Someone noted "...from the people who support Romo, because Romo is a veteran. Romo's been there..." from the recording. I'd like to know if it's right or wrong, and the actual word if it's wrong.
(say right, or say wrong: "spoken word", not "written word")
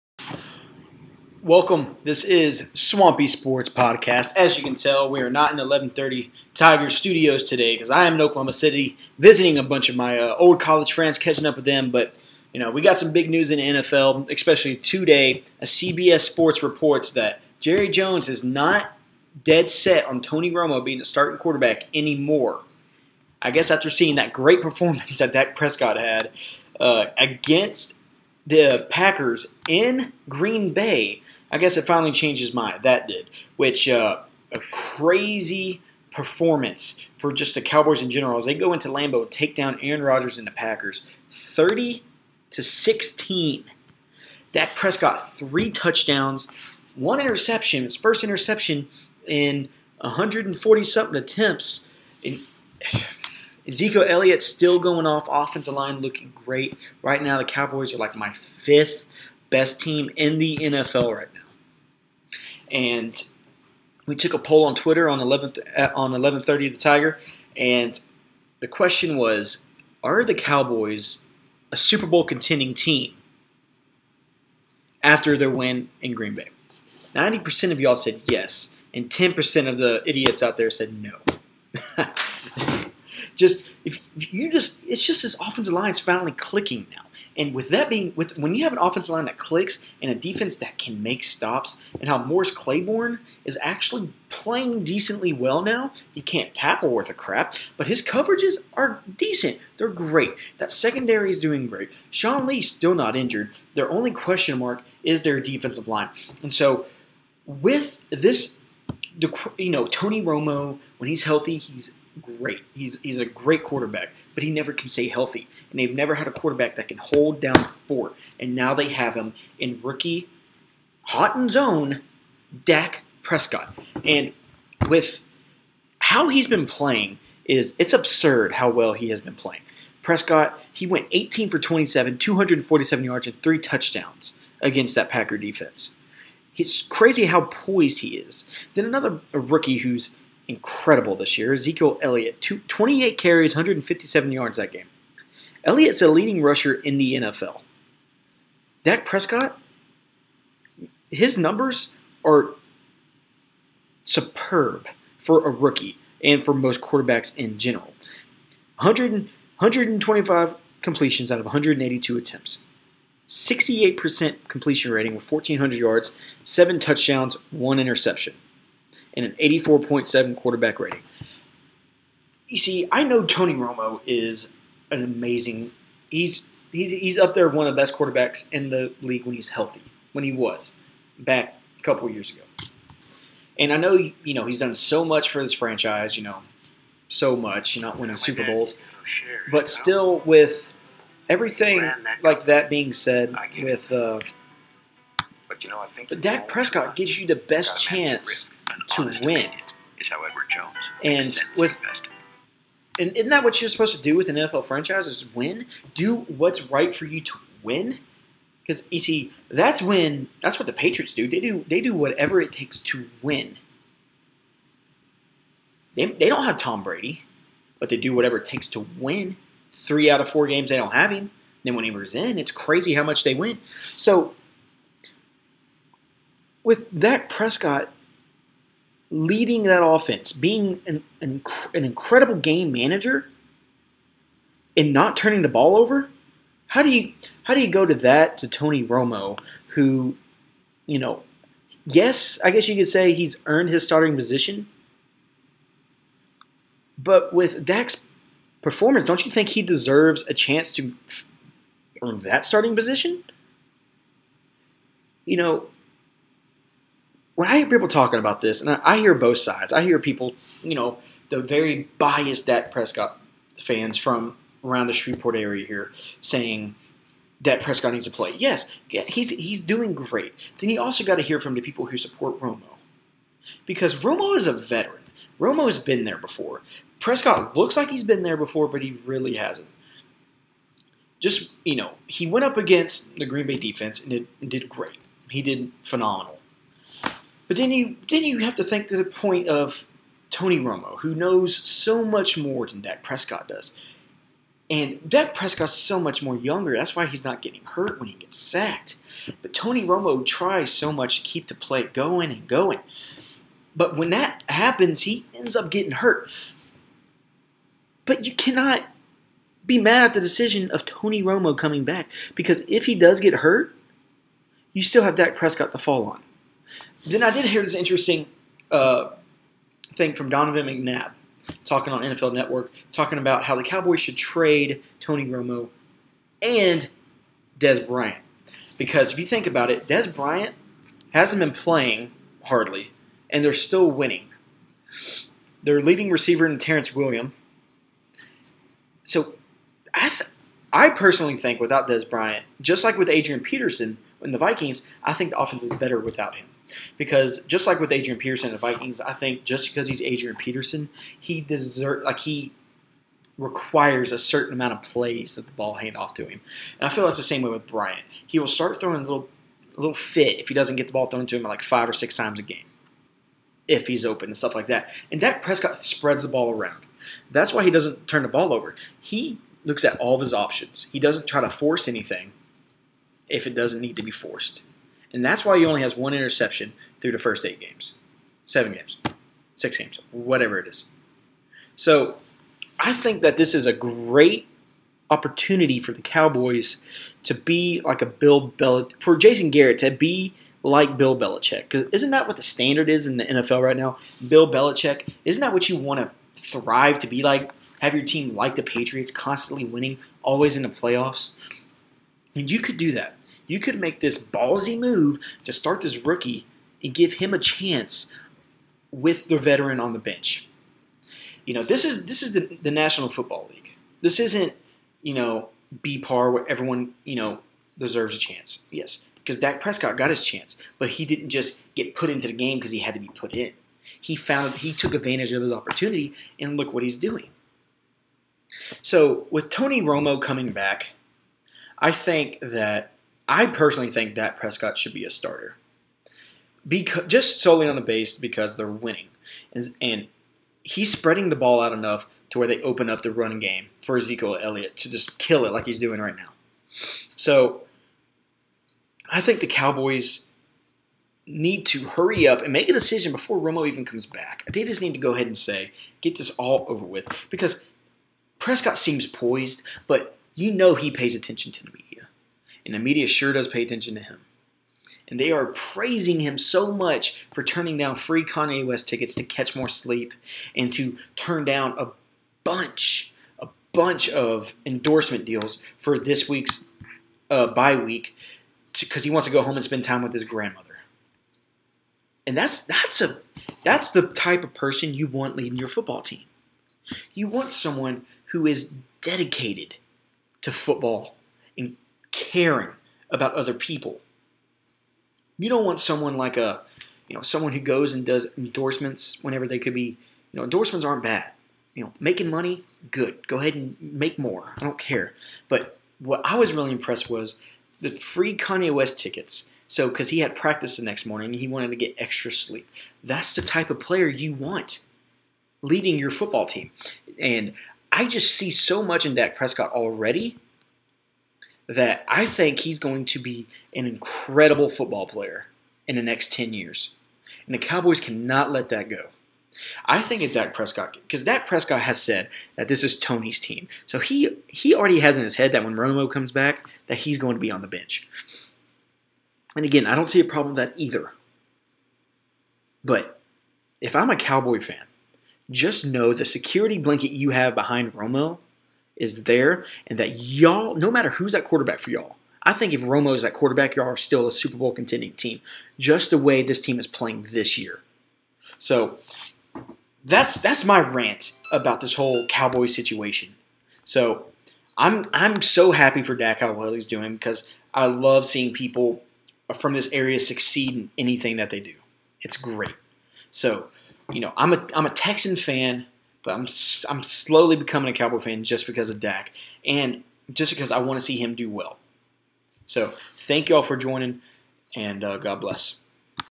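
right.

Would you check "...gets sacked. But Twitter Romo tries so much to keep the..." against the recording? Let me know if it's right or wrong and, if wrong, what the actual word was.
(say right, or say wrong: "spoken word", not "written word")
wrong: "Tony", not "Twitter".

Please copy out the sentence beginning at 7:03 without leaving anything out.
He found he took advantage of his opportunity and look what he's doing.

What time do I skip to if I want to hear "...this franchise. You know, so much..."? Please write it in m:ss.
3:05.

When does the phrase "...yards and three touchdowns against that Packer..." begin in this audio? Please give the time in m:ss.
2:13.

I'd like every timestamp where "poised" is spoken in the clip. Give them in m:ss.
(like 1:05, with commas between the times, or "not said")
2:17, 7:39.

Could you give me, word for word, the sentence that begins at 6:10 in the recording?
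He doesn't try to force anything if it doesn't need to be forced.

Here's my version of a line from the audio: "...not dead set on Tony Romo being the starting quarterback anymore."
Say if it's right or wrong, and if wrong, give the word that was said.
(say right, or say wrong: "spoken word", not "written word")
right.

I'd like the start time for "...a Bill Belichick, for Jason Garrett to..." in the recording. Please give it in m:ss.
6:28.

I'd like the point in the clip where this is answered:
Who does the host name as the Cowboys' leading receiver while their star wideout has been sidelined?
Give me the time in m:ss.
5:36.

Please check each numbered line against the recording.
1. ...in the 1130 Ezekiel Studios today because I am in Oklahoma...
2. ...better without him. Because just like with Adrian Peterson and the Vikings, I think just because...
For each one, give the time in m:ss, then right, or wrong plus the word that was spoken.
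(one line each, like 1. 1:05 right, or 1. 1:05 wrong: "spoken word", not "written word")
1. 0:05 wrong: "Tiger", not "Ezekiel"
2. 5:45 right.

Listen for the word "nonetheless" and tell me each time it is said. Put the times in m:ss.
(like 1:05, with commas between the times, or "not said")
not said.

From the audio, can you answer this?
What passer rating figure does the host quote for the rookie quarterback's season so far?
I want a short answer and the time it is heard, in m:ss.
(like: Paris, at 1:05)
84.7, at 2:49.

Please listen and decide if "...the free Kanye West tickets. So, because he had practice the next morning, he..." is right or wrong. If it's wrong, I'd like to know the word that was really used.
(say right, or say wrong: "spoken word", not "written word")
right.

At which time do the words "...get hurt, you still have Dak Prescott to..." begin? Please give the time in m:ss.
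5:13.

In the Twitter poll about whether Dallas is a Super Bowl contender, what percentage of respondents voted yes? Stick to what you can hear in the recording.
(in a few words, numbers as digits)
90%.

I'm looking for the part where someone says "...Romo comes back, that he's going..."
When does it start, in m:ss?
8:55.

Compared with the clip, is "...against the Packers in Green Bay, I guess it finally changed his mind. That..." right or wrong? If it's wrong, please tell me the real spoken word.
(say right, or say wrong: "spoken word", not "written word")
right.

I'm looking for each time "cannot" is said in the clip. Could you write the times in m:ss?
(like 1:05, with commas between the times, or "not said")
5:08, 8:48.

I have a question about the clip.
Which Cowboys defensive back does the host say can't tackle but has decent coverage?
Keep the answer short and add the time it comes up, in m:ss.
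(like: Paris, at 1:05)
Morris Claiborne, at 1:32.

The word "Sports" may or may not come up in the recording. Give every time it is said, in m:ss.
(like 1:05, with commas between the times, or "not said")
0:03, 0:16.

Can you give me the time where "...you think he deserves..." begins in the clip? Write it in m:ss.
4:09.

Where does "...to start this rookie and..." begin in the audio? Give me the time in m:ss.
6:45.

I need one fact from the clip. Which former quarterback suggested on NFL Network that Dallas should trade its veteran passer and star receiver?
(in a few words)
Donovan McNabb.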